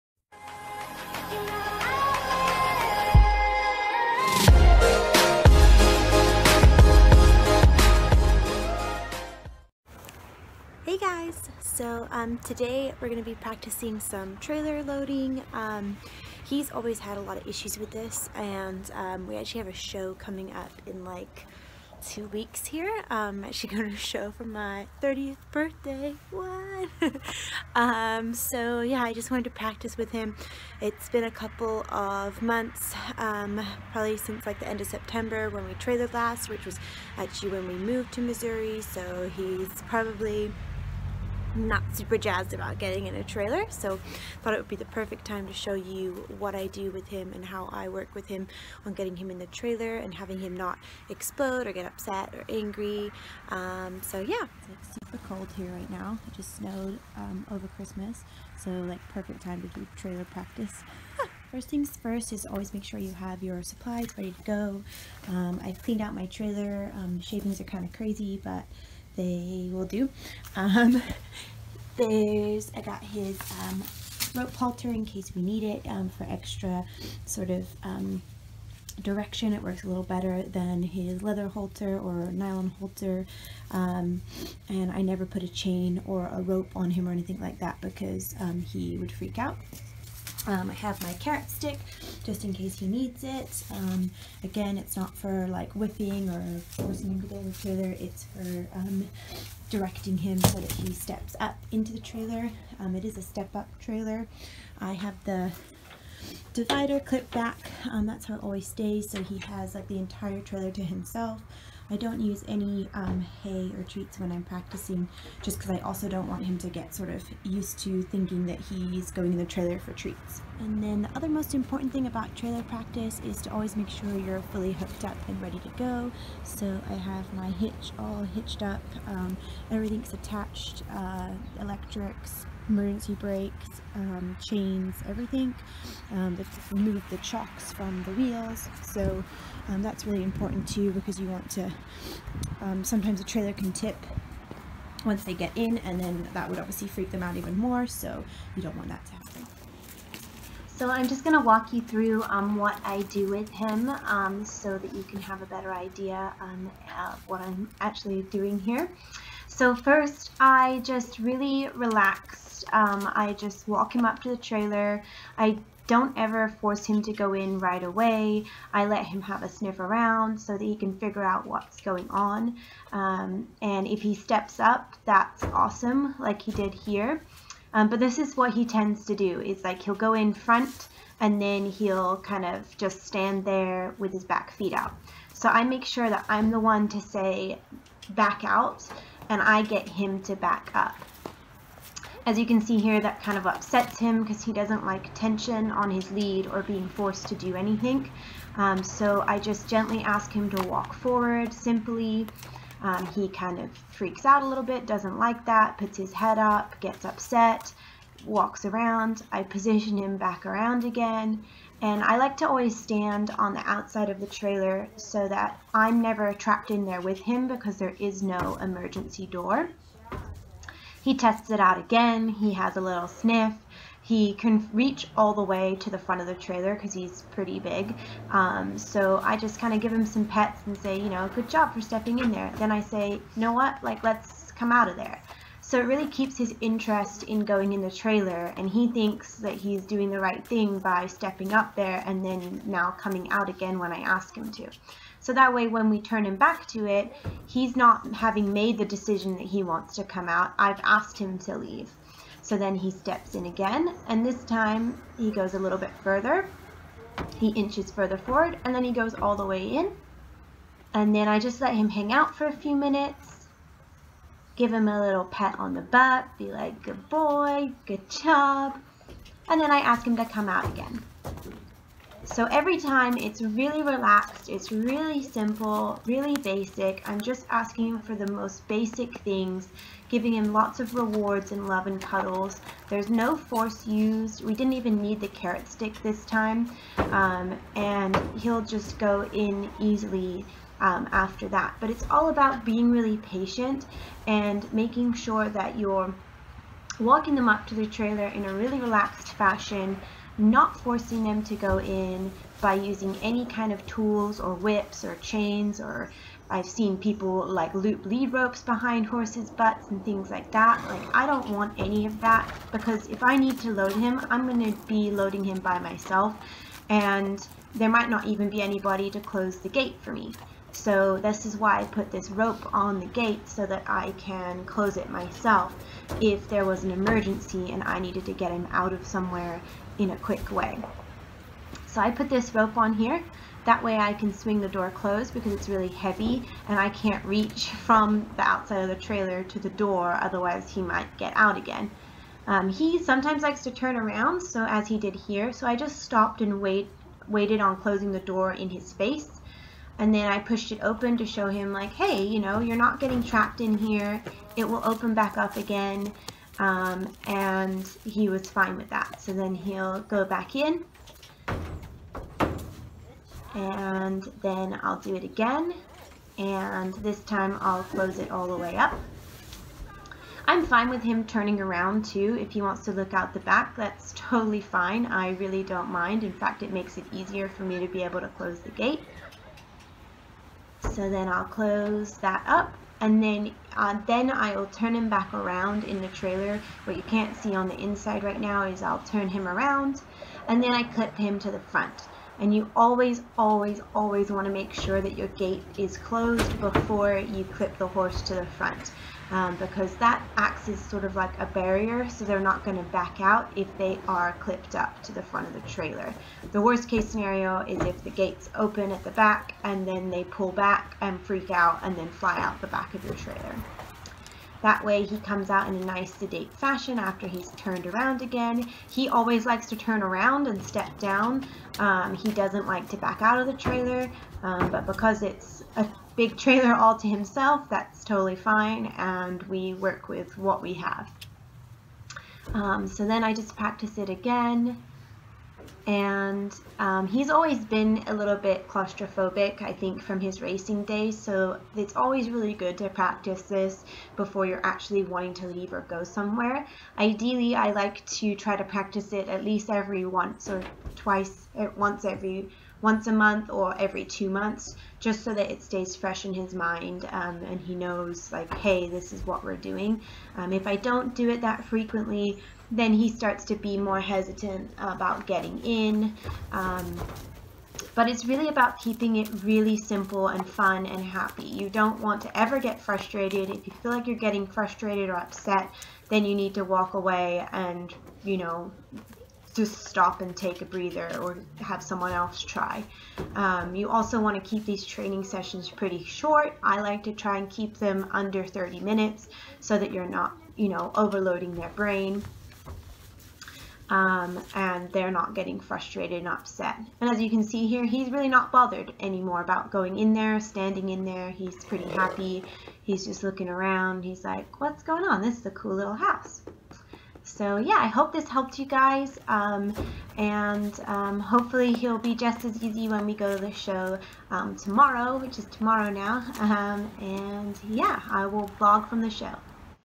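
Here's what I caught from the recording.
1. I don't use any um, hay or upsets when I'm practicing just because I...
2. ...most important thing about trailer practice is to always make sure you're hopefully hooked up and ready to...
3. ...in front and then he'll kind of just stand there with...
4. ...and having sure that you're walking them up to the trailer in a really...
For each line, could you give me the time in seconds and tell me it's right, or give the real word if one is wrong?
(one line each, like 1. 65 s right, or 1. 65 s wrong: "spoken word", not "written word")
1. 111 s wrong: "treats", not "upsets"
2. 121 s wrong: "fully", not "hopefully"
3. 180 s right
4. 294 s wrong: "making", not "having".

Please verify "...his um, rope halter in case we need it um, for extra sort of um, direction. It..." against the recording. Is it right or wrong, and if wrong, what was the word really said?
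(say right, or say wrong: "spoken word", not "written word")
right.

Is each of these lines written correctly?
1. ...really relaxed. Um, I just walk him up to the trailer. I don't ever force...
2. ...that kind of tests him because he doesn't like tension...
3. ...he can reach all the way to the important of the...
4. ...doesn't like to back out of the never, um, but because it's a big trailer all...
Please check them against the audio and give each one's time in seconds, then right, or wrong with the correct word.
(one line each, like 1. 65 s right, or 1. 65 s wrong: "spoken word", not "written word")
1. 161 s right
2. 192 s wrong: "upsets", not "tests"
3. 224 s wrong: "front", not "important"
4. 422 s wrong: "trailer", not "never".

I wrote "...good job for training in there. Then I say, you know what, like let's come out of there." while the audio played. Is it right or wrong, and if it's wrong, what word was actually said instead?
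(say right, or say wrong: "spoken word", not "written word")
wrong: "stepping", not "training".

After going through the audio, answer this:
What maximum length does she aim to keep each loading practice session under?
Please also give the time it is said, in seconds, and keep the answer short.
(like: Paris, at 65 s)
30 minutes, at 488 s.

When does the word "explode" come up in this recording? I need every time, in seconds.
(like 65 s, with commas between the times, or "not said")
51 s.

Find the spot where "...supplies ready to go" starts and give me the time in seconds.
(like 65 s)
63 s.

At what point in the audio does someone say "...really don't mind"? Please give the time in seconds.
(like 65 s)
375 s.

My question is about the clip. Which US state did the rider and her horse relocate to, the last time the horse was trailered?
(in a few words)
Missouri.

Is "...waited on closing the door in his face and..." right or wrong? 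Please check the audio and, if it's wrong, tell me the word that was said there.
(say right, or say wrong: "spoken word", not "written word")
right.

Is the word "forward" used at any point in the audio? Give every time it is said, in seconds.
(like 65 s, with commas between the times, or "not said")
200 s, 258 s.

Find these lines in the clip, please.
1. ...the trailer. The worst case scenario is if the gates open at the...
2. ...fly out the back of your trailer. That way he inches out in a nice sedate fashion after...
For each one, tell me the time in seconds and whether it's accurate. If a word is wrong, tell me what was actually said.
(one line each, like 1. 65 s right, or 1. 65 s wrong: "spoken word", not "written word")
1. 405 s right
2. 412 s wrong: "comes", not "inches".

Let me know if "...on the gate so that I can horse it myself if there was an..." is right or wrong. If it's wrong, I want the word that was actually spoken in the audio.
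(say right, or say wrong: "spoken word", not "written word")
wrong: "close", not "horse".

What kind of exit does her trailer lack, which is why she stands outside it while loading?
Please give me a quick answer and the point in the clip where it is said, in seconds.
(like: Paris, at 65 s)
emergency door, at 218 s.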